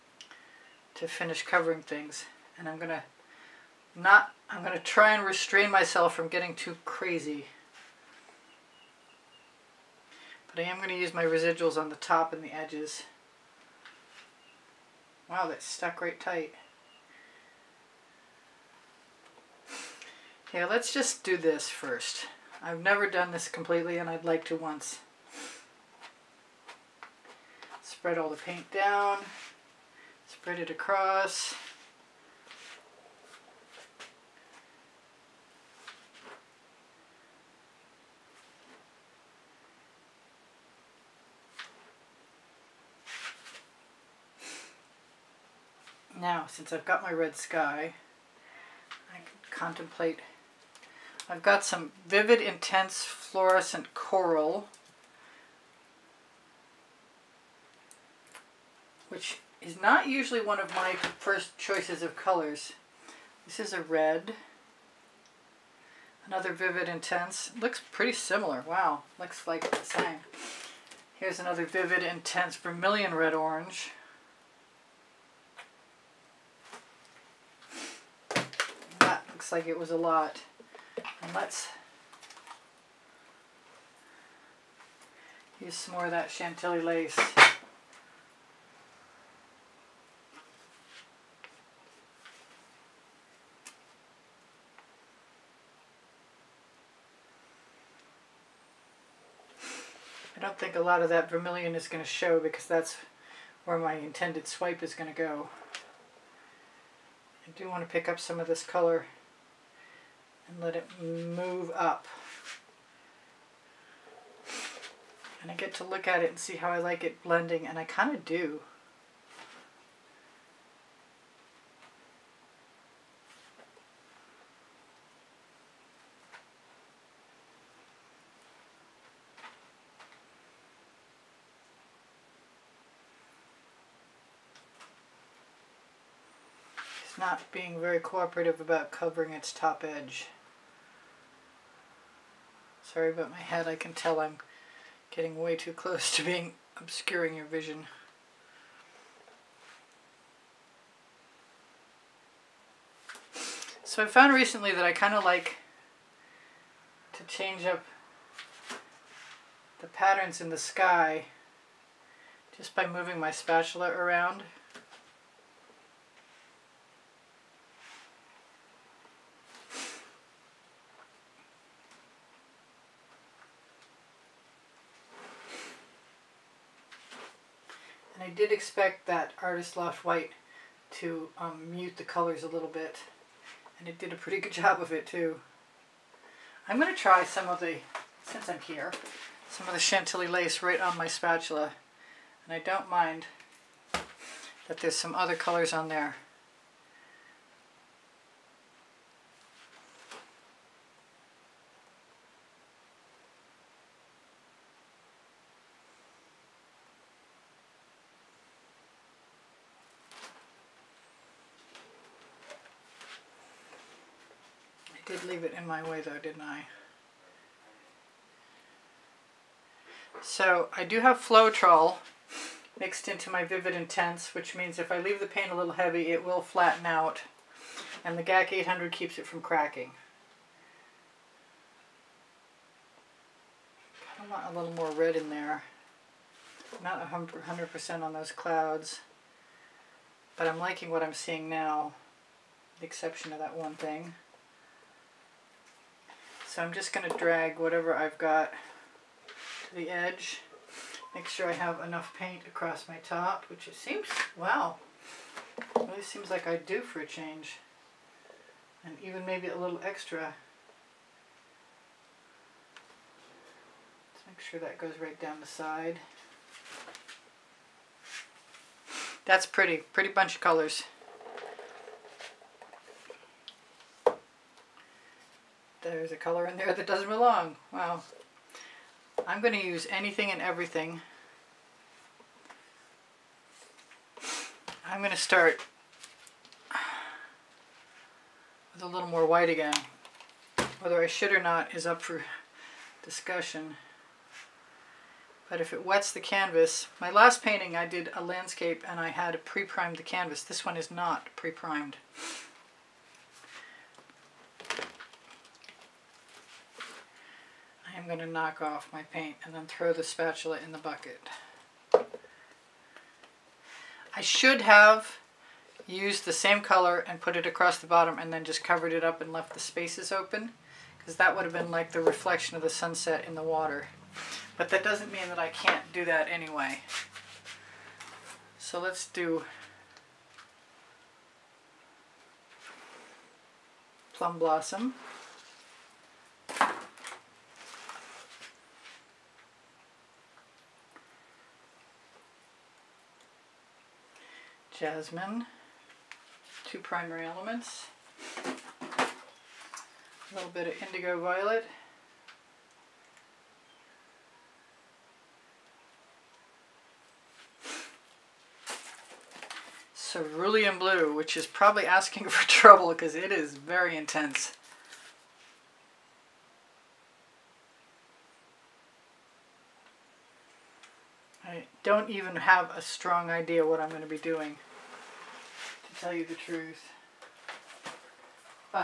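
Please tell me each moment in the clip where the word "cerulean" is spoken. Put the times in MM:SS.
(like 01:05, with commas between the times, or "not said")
05:59.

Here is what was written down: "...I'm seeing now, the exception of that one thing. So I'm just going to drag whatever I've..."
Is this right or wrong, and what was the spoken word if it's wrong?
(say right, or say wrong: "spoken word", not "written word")
right.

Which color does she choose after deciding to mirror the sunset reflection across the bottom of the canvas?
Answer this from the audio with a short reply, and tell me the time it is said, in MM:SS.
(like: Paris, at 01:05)
Plum Blossom, at 05:34.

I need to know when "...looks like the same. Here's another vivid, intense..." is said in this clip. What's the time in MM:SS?
01:09.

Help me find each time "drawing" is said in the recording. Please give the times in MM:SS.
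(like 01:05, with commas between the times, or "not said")
not said.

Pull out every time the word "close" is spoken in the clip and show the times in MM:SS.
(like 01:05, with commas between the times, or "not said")
02:25.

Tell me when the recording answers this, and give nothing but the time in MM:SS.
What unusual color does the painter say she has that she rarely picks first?
00:53.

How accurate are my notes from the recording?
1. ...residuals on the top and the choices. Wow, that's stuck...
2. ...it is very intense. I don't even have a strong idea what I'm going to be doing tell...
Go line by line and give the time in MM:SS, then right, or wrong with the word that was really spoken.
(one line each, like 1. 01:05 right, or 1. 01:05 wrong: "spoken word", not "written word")
1. 00:11 wrong: "edges", not "choices"
2. 06:03 right.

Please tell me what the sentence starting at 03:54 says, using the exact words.
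I want a little more red in there.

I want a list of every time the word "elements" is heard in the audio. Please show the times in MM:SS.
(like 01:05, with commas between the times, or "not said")
05:47.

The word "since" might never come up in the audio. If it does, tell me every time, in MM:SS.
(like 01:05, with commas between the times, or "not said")
00:46, 03:08.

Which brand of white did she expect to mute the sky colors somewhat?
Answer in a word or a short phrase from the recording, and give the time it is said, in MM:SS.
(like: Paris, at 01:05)
Artist Loft, at 02:59.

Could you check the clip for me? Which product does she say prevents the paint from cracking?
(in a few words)
GAC 800.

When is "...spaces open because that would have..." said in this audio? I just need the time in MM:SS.
05:19.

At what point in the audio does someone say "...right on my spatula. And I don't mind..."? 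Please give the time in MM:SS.
03:10.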